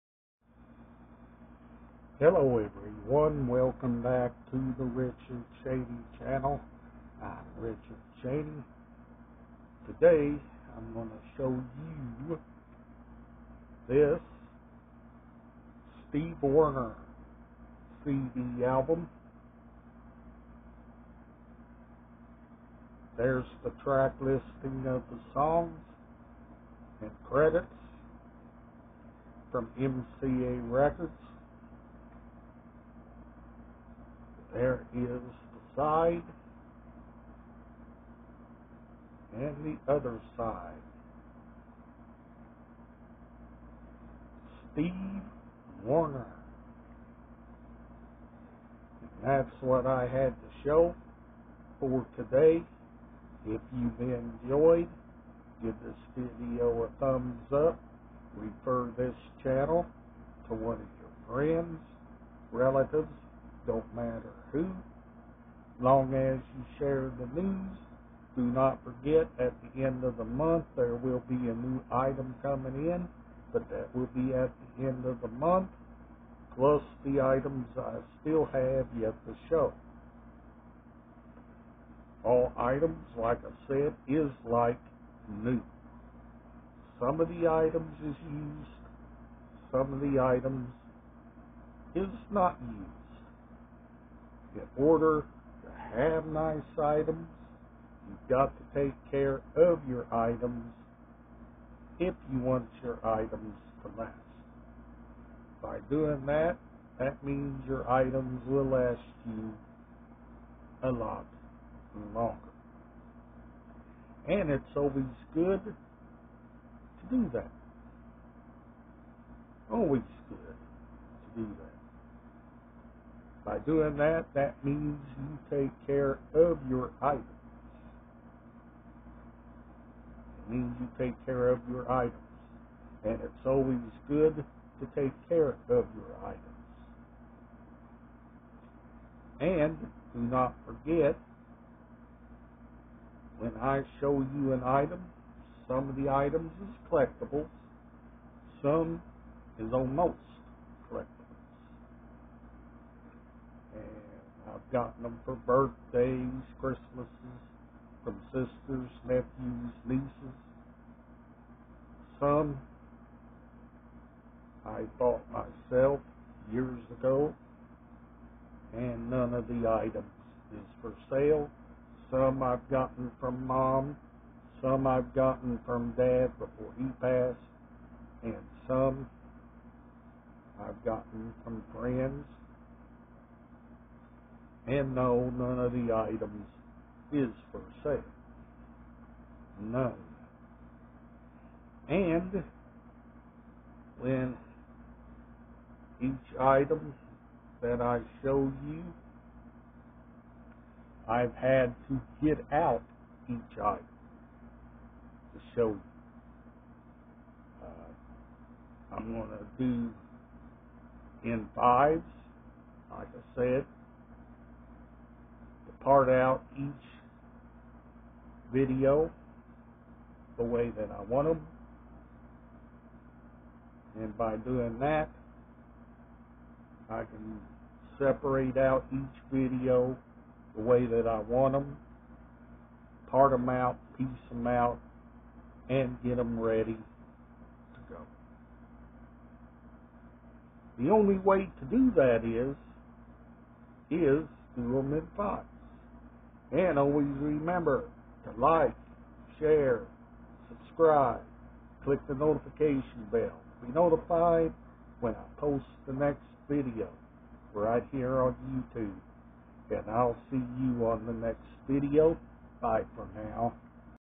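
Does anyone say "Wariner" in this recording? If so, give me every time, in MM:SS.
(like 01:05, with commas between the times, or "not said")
00:16, 00:45.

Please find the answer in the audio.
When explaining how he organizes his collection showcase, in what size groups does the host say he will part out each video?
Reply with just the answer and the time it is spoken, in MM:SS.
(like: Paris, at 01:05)
Fives, at 03:31.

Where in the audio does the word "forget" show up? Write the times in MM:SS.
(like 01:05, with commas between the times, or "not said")
01:08, 02:20.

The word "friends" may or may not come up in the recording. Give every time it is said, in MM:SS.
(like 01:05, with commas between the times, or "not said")
01:01, 03:01.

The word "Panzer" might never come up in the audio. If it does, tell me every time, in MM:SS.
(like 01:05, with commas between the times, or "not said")
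not said.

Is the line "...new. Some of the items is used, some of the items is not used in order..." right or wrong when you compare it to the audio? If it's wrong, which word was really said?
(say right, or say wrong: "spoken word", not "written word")
right.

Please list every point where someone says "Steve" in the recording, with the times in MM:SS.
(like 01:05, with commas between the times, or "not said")
00:16, 00:44.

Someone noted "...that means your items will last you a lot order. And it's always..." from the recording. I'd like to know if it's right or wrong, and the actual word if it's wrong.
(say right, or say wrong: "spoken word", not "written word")
wrong: "longer", not "order".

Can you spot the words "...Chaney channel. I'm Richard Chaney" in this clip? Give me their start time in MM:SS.
00:05.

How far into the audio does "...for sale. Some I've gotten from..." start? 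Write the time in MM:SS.
02:50.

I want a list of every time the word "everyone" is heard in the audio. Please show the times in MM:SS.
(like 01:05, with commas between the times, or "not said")
00:02.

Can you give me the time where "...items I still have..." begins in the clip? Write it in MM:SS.
01:17.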